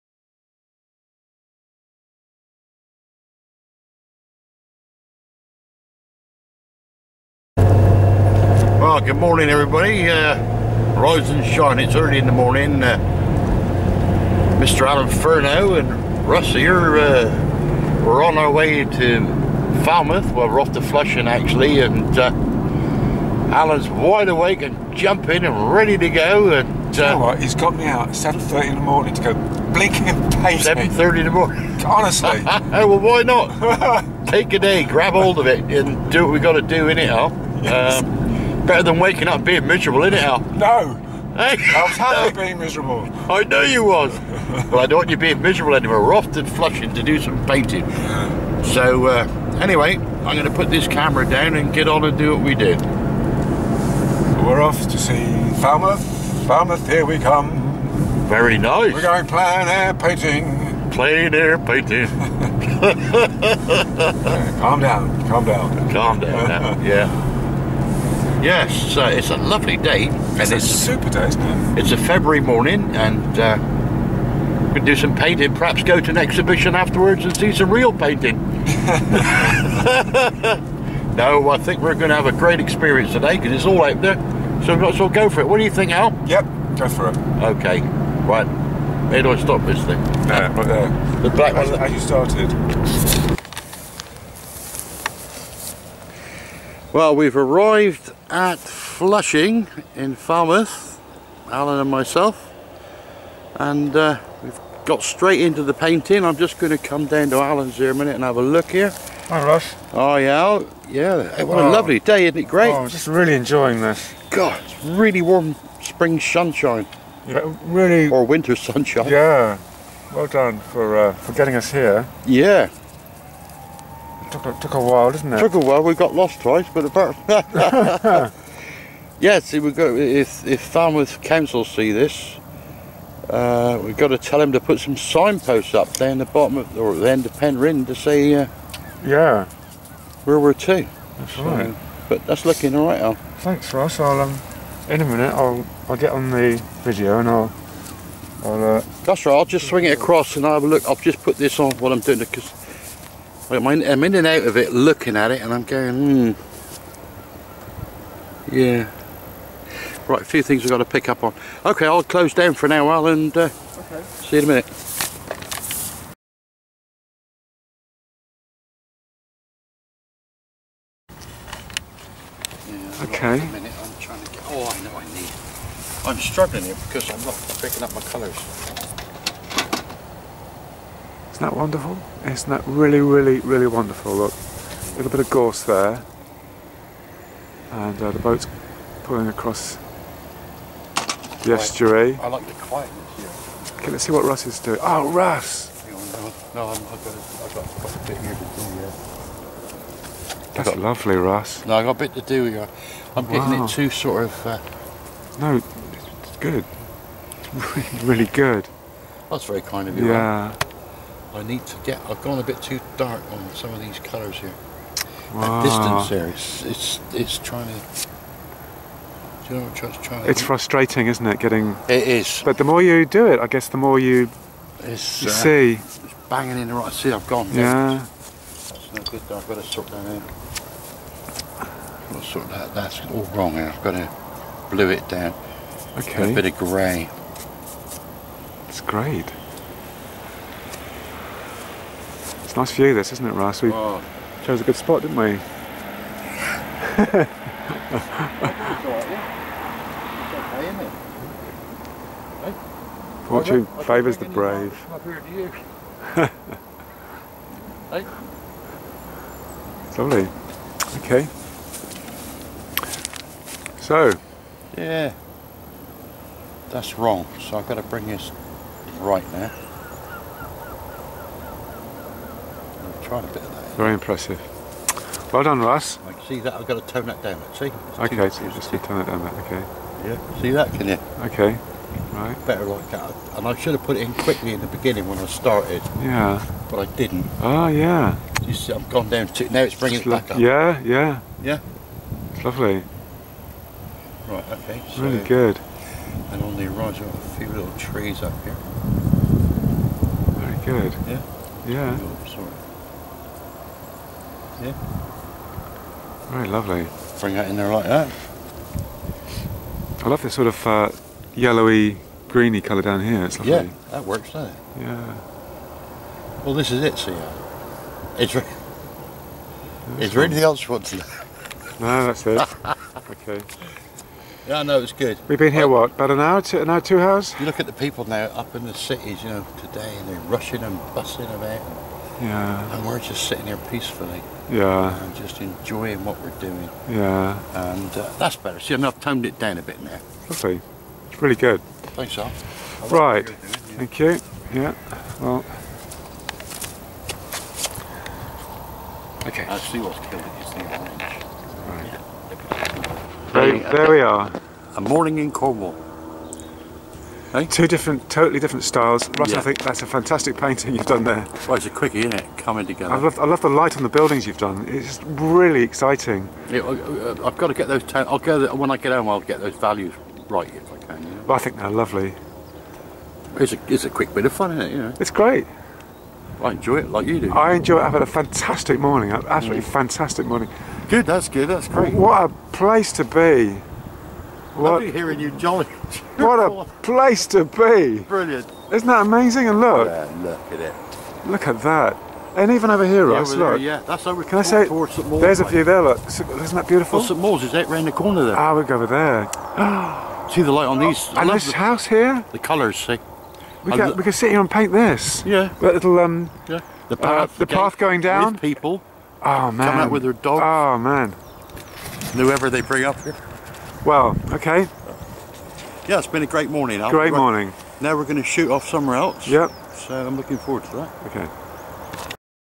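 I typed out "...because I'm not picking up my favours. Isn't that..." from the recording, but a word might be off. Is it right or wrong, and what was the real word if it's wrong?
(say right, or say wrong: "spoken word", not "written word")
wrong: "colours", not "favours".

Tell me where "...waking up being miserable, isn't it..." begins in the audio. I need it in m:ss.
0:38.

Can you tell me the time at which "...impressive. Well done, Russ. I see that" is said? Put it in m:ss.
4:33.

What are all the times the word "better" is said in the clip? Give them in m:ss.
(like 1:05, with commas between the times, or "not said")
0:38, 4:42, 5:38.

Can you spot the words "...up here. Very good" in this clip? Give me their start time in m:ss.
4:58.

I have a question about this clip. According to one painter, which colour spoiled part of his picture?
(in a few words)
Orange.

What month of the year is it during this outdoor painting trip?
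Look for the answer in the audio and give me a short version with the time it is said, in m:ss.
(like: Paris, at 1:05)
February, at 1:11.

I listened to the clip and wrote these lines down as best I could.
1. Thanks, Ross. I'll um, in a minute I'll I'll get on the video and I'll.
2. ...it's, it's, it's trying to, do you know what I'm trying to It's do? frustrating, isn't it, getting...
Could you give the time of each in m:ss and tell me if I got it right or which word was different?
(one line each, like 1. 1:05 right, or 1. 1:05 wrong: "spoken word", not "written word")
1. 2:23 right
2. 3:36 right.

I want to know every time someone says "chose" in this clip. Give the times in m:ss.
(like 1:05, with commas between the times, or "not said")
4:04.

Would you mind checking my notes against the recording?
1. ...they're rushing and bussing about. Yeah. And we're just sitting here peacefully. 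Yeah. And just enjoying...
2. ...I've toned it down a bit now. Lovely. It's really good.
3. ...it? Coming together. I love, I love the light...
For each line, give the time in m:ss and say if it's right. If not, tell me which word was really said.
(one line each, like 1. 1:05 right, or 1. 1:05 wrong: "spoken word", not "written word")
1. 5:30 right
2. 5:38 right
3. 6:02 right.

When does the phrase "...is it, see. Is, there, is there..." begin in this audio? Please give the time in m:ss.
5:16.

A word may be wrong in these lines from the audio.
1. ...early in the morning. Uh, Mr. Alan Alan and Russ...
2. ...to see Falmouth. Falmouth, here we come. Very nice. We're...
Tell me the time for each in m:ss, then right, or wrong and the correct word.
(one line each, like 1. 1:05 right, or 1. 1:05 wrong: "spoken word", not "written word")
1. 0:11 wrong: "Furneaux", not "Alan"
2. 0:54 right.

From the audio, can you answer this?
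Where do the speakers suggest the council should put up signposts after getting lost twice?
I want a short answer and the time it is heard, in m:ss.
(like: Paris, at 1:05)
Penryn, at 2:17.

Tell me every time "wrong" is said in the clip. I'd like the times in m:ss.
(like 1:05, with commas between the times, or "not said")
3:53, 4:26.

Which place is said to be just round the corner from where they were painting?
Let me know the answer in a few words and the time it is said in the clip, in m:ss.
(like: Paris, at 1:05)
St. Mawes, at 6:37.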